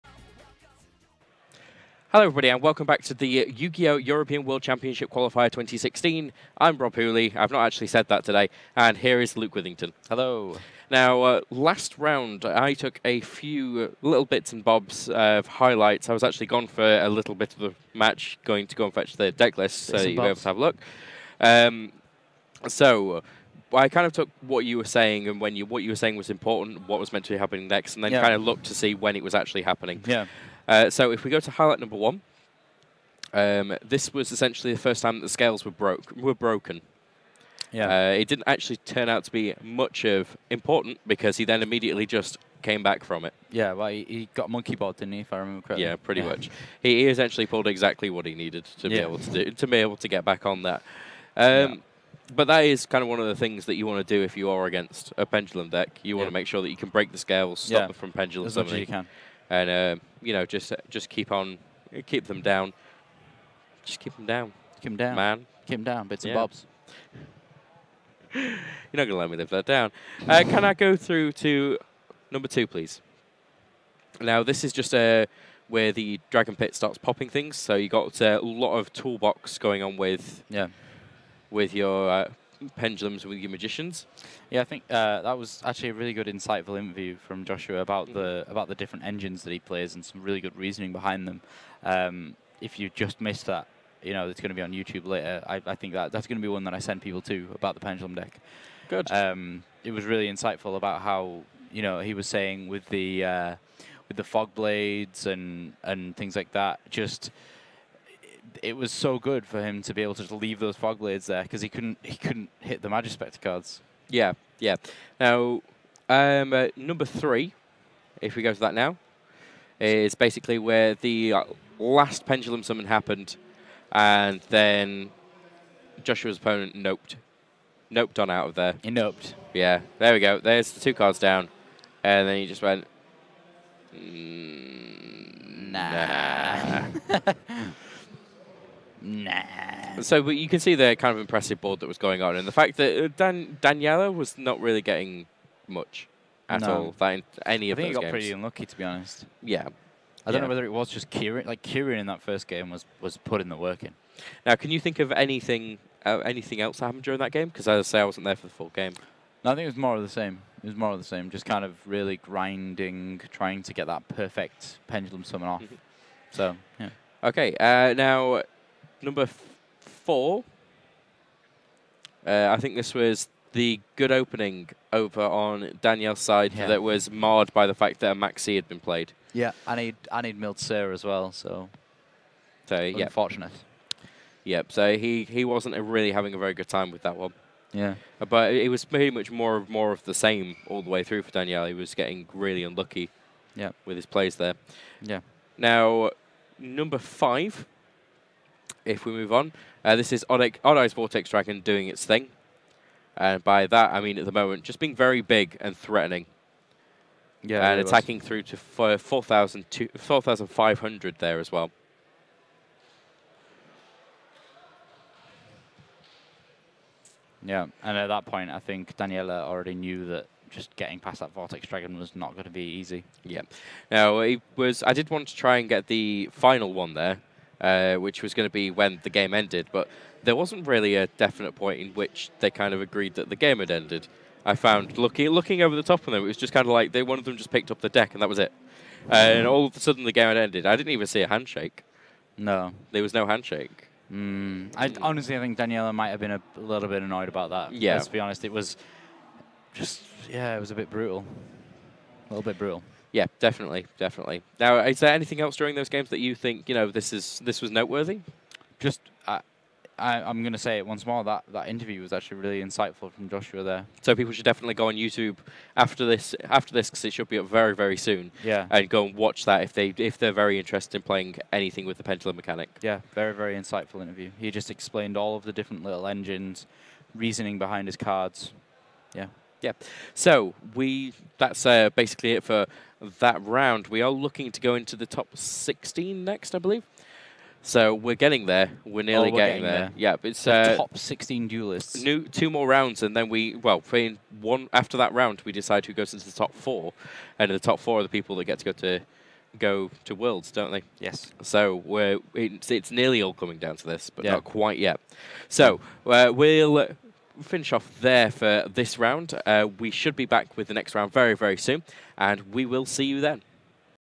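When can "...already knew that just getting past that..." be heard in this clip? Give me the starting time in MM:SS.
03:39.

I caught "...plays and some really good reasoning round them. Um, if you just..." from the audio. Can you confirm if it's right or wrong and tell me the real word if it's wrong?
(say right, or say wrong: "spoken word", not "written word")
wrong: "behind", not "round".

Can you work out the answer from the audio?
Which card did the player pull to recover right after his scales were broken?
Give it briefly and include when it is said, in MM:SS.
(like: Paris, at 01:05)
Monkeyboard, at 00:44.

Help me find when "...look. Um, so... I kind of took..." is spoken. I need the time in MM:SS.
00:20.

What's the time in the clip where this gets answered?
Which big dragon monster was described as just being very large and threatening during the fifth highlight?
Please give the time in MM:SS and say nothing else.
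03:20.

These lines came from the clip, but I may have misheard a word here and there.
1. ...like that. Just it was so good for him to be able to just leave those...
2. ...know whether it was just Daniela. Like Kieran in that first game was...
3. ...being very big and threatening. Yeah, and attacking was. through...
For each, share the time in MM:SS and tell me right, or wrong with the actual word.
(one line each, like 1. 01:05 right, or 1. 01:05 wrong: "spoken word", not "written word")
1. 01:46 right
2. 02:30 wrong: "Kieran", not "Daniela"
3. 03:24 right.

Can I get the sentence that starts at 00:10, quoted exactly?
Now, uh, last round, I took a few little bits and bobs of highlights.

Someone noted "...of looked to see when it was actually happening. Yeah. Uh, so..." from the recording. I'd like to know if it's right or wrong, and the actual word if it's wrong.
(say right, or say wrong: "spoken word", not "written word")
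right.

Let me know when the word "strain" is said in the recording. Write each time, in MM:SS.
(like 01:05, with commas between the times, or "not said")
not said.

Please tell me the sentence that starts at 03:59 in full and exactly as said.
Uh, and all of a sudden the game had ended.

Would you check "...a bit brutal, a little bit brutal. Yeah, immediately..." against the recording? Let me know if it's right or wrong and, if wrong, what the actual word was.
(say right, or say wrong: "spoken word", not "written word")
wrong: "definitely", not "immediately".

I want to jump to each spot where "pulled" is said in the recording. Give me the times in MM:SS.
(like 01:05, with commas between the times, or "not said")
00:47.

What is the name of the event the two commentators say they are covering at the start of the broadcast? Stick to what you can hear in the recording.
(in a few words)
European World Championship Qualifier 2016.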